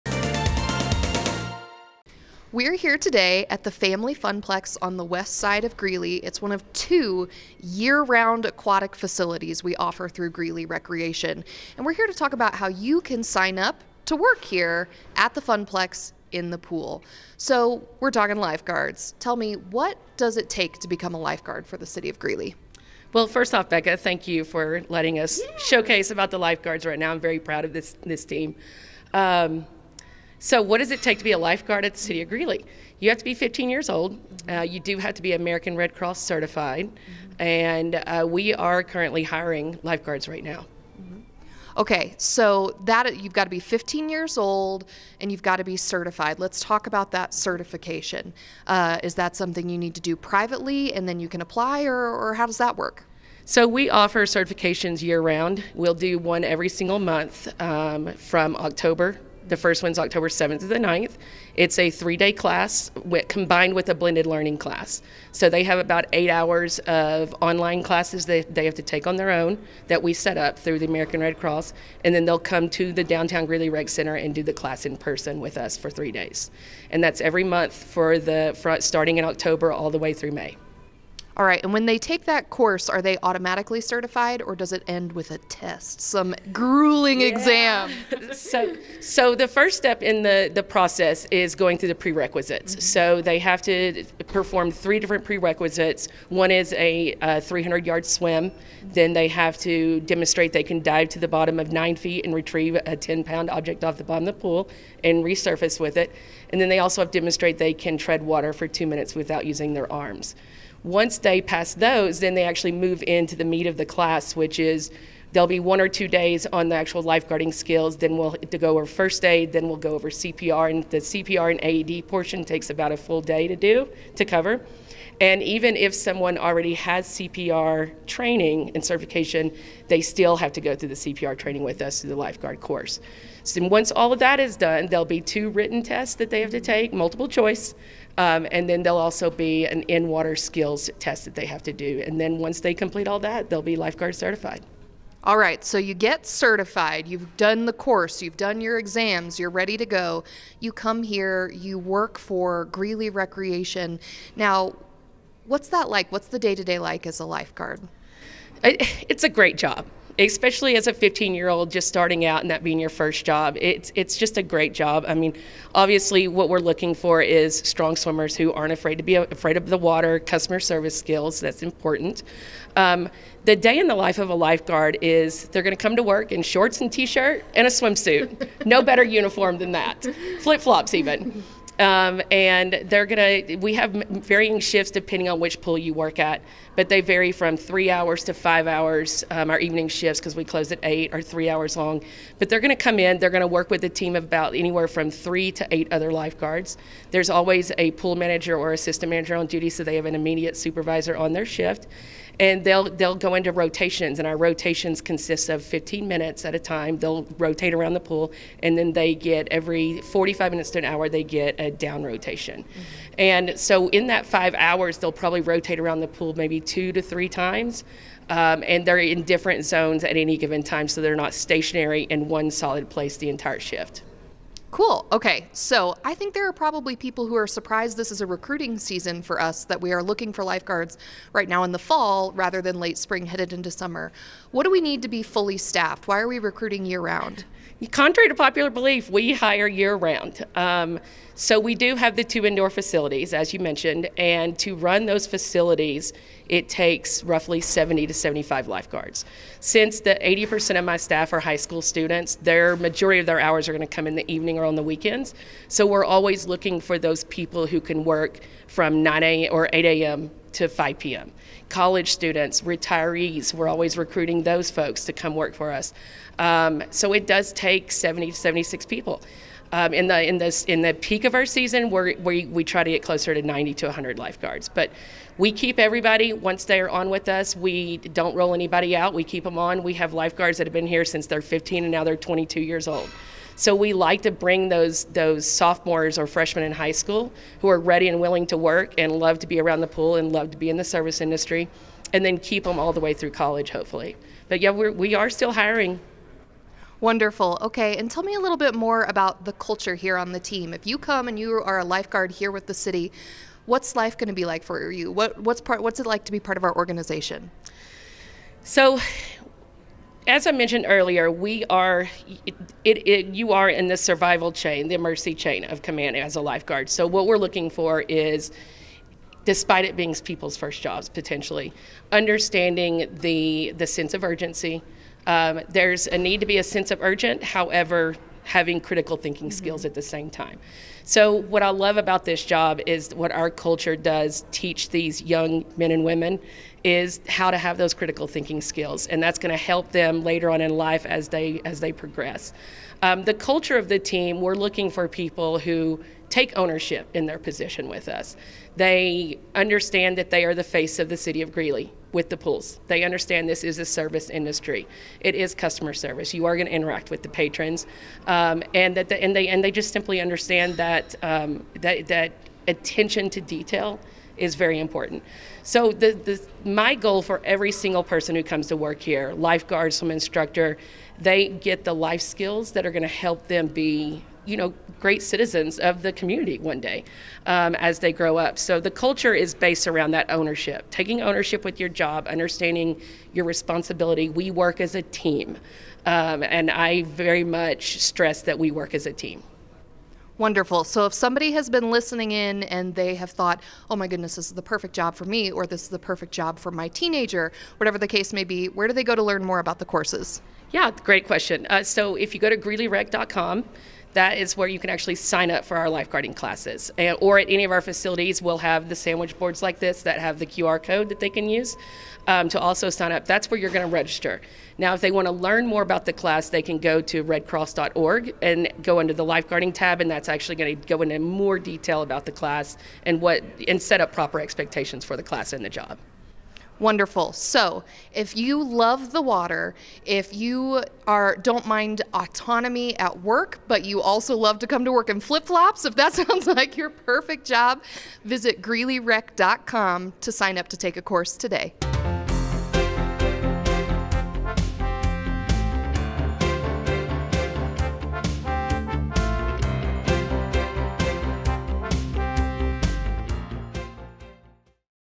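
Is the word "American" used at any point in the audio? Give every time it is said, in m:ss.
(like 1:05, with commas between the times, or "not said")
0:35, 1:10.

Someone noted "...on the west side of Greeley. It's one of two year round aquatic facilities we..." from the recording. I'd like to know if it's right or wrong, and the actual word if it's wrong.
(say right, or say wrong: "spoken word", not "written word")
right.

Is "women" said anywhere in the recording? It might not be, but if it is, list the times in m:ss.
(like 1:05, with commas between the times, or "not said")
5:36.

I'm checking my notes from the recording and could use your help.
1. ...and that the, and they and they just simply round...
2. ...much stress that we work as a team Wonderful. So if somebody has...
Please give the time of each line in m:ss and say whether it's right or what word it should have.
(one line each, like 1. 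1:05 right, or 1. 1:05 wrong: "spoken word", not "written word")
1. 5:58 wrong: "understand", not "round"
2. 6:27 right.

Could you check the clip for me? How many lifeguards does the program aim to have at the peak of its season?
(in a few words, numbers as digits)
90 to 100.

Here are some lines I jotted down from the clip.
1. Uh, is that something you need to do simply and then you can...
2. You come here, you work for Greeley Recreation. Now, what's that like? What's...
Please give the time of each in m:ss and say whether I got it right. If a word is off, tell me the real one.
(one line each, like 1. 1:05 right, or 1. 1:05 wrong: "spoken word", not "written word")
1. 0:48 wrong: "privately", not "simply"
2. 2:30 right.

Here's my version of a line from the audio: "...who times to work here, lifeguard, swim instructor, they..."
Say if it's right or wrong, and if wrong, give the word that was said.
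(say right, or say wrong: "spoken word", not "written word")
wrong: "comes", not "times".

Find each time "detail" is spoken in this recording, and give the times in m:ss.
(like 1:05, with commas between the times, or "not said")
6:03, 7:01.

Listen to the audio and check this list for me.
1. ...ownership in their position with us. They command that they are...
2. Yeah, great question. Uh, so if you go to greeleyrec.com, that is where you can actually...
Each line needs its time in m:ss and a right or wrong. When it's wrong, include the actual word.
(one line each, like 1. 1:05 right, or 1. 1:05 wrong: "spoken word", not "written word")
1. 5:46 wrong: "understand", not "command"
2. 6:40 right.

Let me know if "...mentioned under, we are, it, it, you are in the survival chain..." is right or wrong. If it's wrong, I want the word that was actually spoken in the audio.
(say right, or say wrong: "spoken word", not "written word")
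wrong: "earlier", not "under".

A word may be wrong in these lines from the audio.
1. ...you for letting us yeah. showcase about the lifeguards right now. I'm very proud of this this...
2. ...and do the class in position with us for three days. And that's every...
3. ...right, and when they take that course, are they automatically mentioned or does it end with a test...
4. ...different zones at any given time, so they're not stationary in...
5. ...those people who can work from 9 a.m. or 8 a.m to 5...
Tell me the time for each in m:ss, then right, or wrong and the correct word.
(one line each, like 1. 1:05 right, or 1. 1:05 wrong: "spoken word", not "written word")
1. 0:24 right
2. 1:14 wrong: "person", not "position"
3. 1:21 wrong: "certified", not "mentioned"
4. 3:39 right
5. 4:16 right.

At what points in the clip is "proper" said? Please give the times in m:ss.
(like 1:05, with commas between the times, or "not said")
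7:04.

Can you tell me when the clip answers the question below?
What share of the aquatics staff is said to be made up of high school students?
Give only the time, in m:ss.
4:10.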